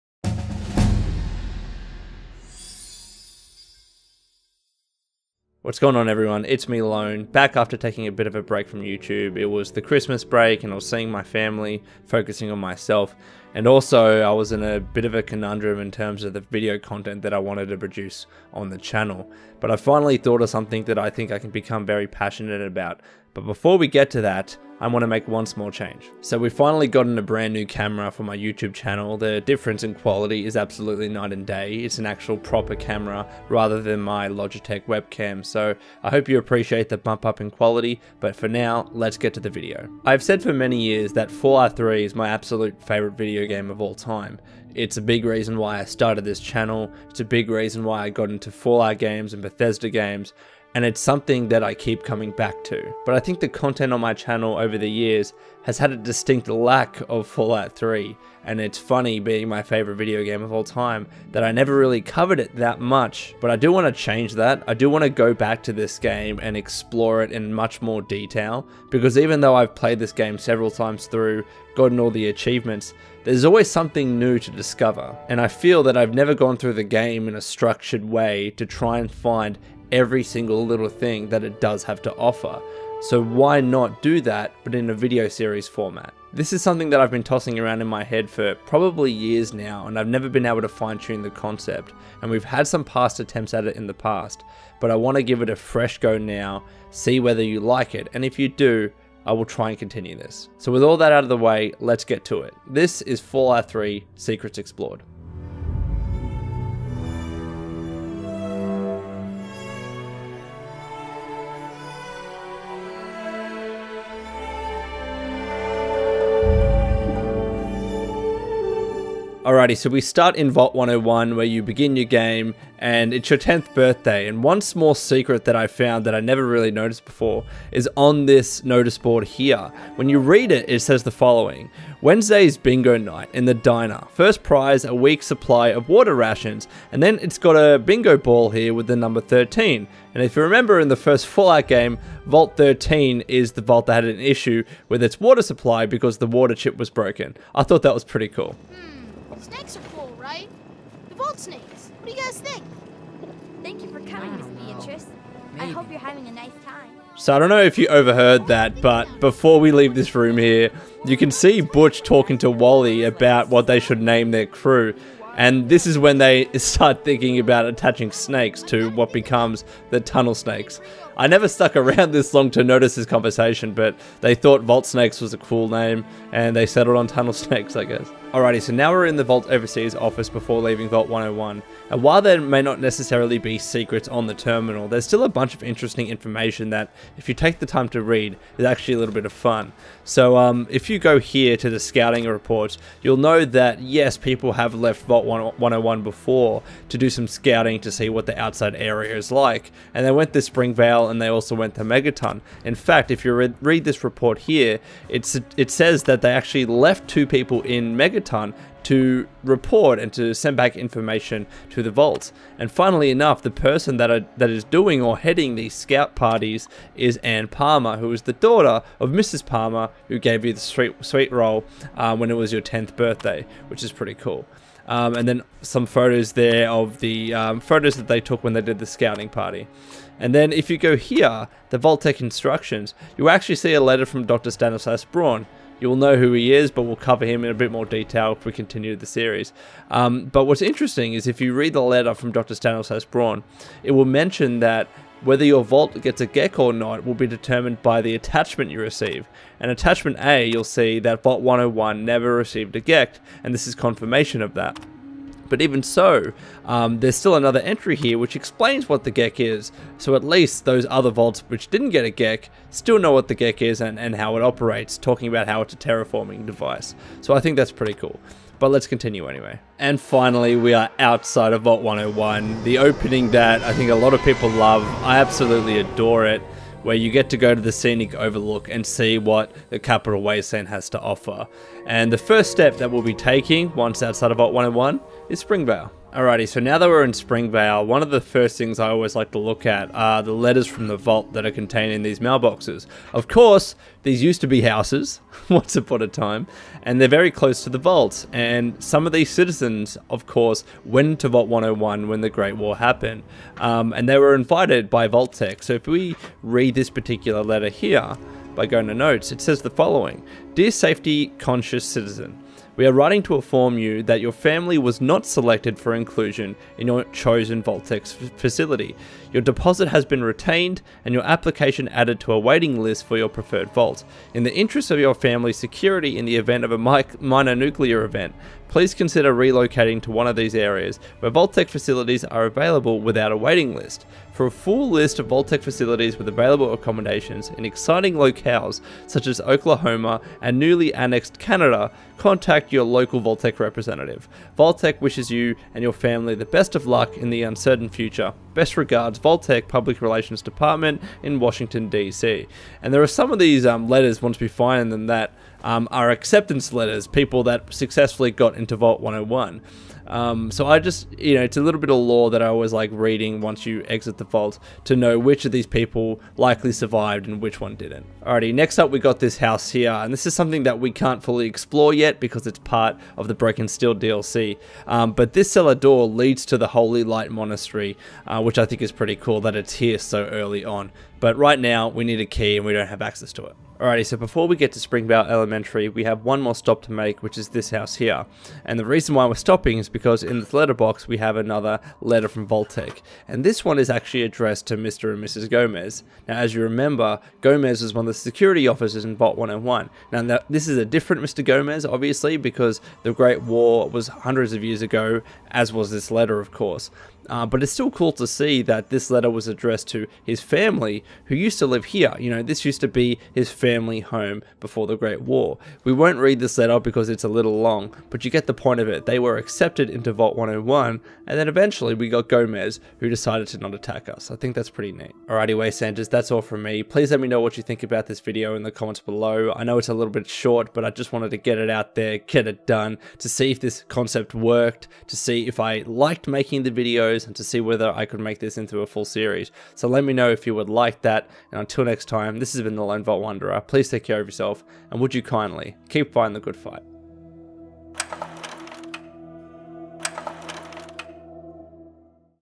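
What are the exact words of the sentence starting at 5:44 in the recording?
Tech wishes you and your family the best of luck in the uncertain future.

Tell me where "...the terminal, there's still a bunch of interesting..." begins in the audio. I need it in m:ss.
3:04.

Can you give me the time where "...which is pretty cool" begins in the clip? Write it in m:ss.
3:43.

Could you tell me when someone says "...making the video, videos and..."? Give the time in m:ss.
7:16.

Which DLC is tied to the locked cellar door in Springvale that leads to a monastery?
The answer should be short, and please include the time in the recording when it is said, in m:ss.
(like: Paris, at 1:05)
Broken Steel, at 6:13.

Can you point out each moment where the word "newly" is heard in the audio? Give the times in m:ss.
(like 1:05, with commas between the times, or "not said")
5:40.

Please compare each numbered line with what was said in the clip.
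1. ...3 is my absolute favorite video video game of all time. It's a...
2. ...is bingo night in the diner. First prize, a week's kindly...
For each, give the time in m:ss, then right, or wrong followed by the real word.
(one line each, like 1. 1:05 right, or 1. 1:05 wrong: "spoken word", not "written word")
1. 0:41 right
2. 2:12 wrong: "supply", not "kindly".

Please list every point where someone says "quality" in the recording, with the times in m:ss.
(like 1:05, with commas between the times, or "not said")
0:29, 0:37.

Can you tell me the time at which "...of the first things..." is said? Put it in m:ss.
4:48.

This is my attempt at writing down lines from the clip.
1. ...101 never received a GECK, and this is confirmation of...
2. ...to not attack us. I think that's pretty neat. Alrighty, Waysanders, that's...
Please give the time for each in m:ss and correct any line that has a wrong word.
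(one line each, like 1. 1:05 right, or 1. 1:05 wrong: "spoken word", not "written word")
1. 4:11 right
2. 7:03 right.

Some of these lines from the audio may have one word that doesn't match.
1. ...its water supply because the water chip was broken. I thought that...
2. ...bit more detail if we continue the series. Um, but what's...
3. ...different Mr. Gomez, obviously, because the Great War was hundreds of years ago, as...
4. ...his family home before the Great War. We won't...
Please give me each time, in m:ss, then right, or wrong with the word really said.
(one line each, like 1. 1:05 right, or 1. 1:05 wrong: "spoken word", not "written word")
1. 2:25 right
2. 3:57 right
3. 6:40 right
4. 6:53 right.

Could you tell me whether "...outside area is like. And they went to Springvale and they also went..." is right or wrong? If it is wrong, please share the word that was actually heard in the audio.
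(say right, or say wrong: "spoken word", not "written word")
right.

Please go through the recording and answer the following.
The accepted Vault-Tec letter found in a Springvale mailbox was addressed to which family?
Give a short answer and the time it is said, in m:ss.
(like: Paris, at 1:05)
Mr. and Mrs. Gomez, at 6:34.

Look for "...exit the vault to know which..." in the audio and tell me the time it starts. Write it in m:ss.
6:03.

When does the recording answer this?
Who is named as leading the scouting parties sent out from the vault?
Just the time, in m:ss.
3:37.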